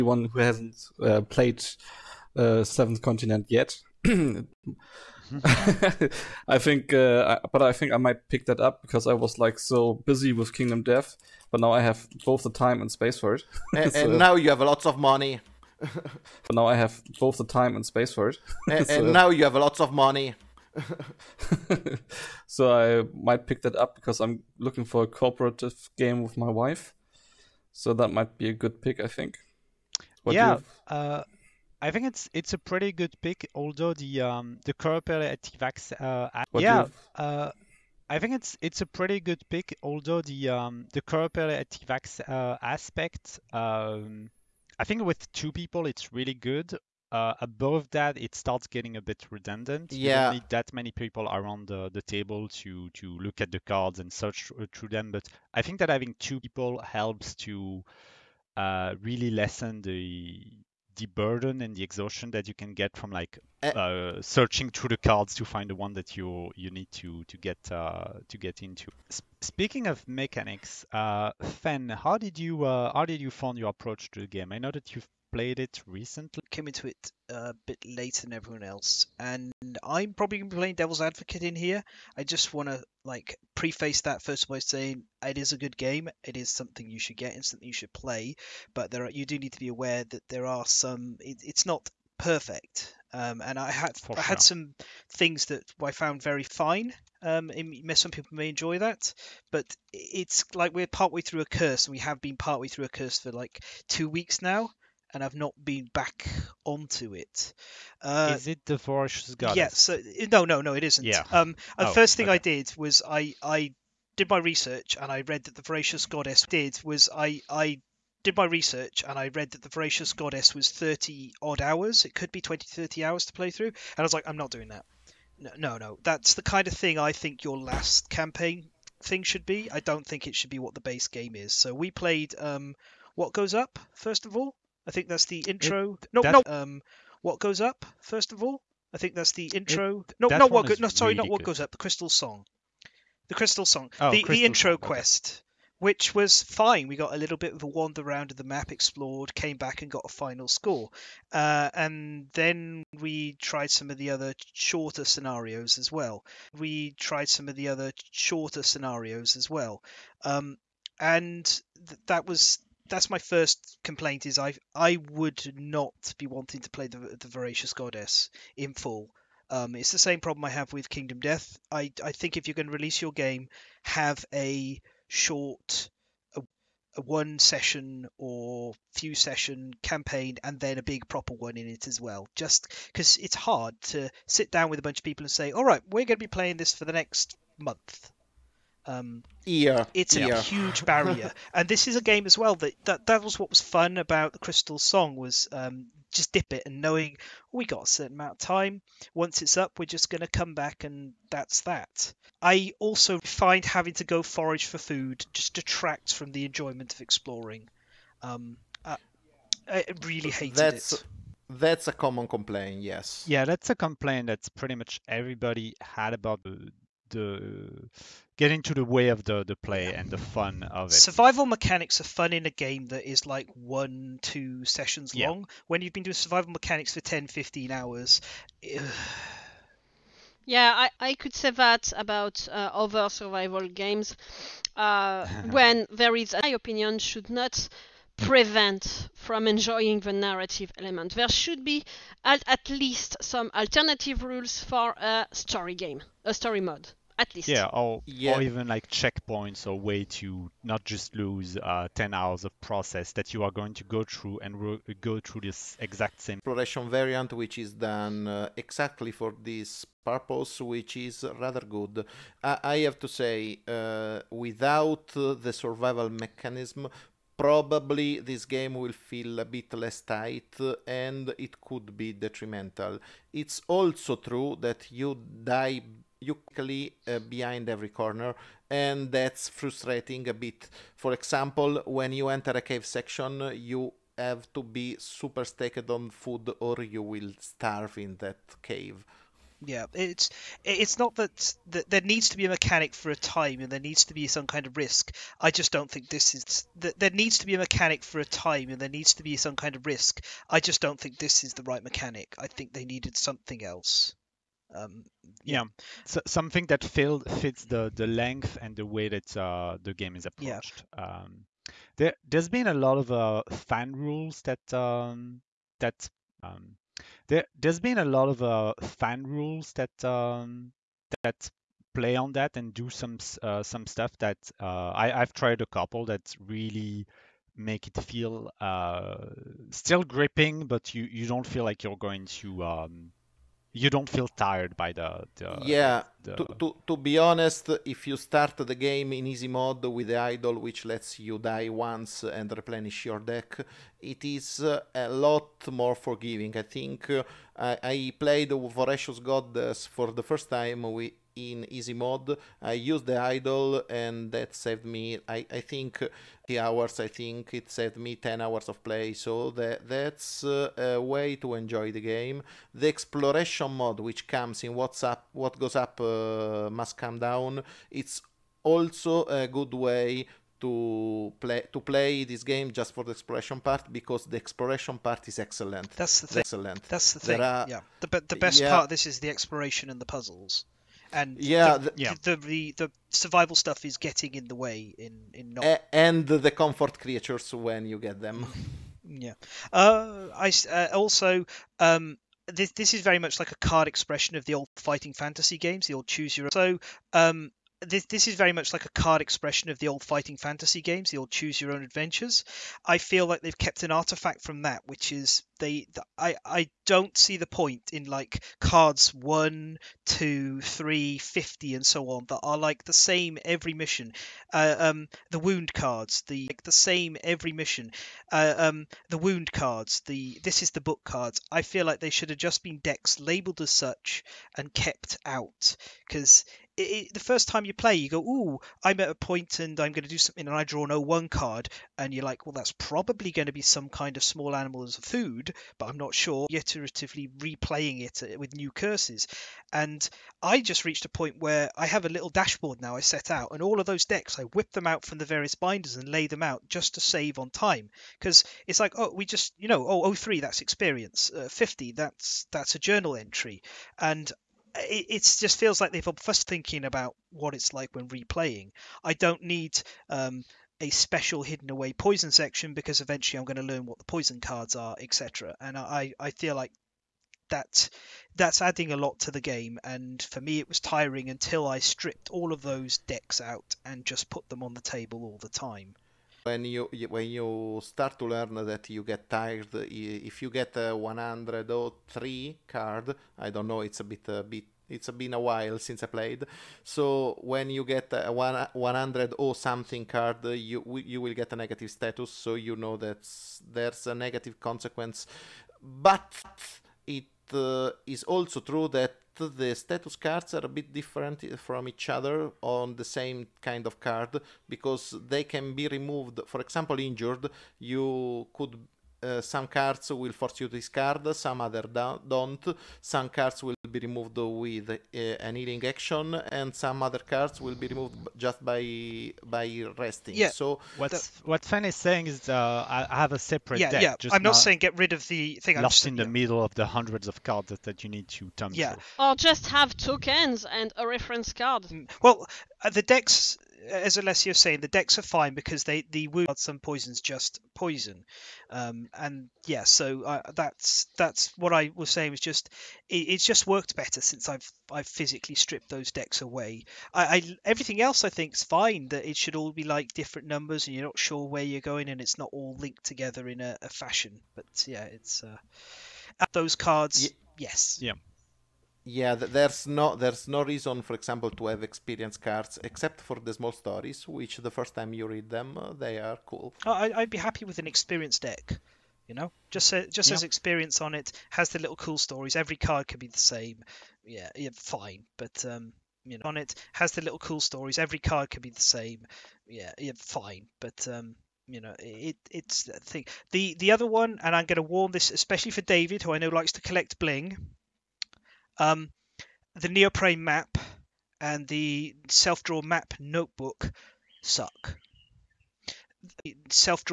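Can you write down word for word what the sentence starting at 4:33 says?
It's also true that you die you quickly uh, behind every corner and that's frustrating a bit.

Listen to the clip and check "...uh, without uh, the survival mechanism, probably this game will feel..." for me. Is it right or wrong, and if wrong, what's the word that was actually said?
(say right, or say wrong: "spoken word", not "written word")
right.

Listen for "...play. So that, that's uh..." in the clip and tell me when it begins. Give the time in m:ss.
5:58.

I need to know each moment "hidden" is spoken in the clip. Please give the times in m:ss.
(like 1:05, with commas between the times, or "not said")
7:41.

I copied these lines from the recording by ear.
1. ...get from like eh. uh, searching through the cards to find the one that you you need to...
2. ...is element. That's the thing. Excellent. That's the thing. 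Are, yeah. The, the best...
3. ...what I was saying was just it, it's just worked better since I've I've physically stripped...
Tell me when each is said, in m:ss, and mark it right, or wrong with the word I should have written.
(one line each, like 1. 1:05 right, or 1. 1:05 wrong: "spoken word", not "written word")
1. 1:02 right
2. 6:15 wrong: "excellent", not "element"
3. 9:01 right.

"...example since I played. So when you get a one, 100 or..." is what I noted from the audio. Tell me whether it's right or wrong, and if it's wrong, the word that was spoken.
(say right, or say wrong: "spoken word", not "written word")
wrong: "while", not "example".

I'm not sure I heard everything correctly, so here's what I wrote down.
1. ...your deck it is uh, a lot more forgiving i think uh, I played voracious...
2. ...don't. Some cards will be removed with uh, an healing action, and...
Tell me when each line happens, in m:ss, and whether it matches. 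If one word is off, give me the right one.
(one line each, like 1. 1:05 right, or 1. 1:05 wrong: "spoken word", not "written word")
1. 5:43 right
2. 8:32 right.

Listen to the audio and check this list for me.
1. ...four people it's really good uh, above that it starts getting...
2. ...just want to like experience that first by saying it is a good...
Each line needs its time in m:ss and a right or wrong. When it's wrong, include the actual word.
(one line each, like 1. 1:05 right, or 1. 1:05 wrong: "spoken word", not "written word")
1. 0:45 wrong: "two", not "four"
2. 1:22 wrong: "preface", not "experience".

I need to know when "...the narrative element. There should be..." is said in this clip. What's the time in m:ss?
4:00.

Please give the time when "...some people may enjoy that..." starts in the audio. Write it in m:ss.
1:37.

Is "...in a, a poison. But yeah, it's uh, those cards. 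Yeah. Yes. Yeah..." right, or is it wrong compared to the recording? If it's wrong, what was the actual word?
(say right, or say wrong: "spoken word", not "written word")
wrong: "fashion", not "poison".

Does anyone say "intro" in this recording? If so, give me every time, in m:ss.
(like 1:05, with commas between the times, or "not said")
2:15, 2:19, 2:24.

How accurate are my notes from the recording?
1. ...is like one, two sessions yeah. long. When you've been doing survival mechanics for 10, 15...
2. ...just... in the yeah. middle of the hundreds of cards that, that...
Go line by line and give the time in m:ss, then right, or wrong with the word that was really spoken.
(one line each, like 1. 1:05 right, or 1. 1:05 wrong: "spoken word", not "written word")
1. 3:43 right
2. 8:45 right.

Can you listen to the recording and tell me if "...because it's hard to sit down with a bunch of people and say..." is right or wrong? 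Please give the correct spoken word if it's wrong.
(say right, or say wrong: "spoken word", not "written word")
right.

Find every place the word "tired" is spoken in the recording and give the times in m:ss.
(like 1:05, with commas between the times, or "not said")
5:34, 7:59.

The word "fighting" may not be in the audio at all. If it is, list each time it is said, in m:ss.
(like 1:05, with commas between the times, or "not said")
6:34, 6:40.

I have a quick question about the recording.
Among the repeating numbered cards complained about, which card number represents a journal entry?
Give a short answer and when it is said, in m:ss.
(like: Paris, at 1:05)
50, at 7:31.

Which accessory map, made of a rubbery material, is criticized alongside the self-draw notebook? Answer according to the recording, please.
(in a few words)
neoprene map.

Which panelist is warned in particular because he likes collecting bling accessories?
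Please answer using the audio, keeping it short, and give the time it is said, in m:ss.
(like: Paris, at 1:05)
David, at 9:45.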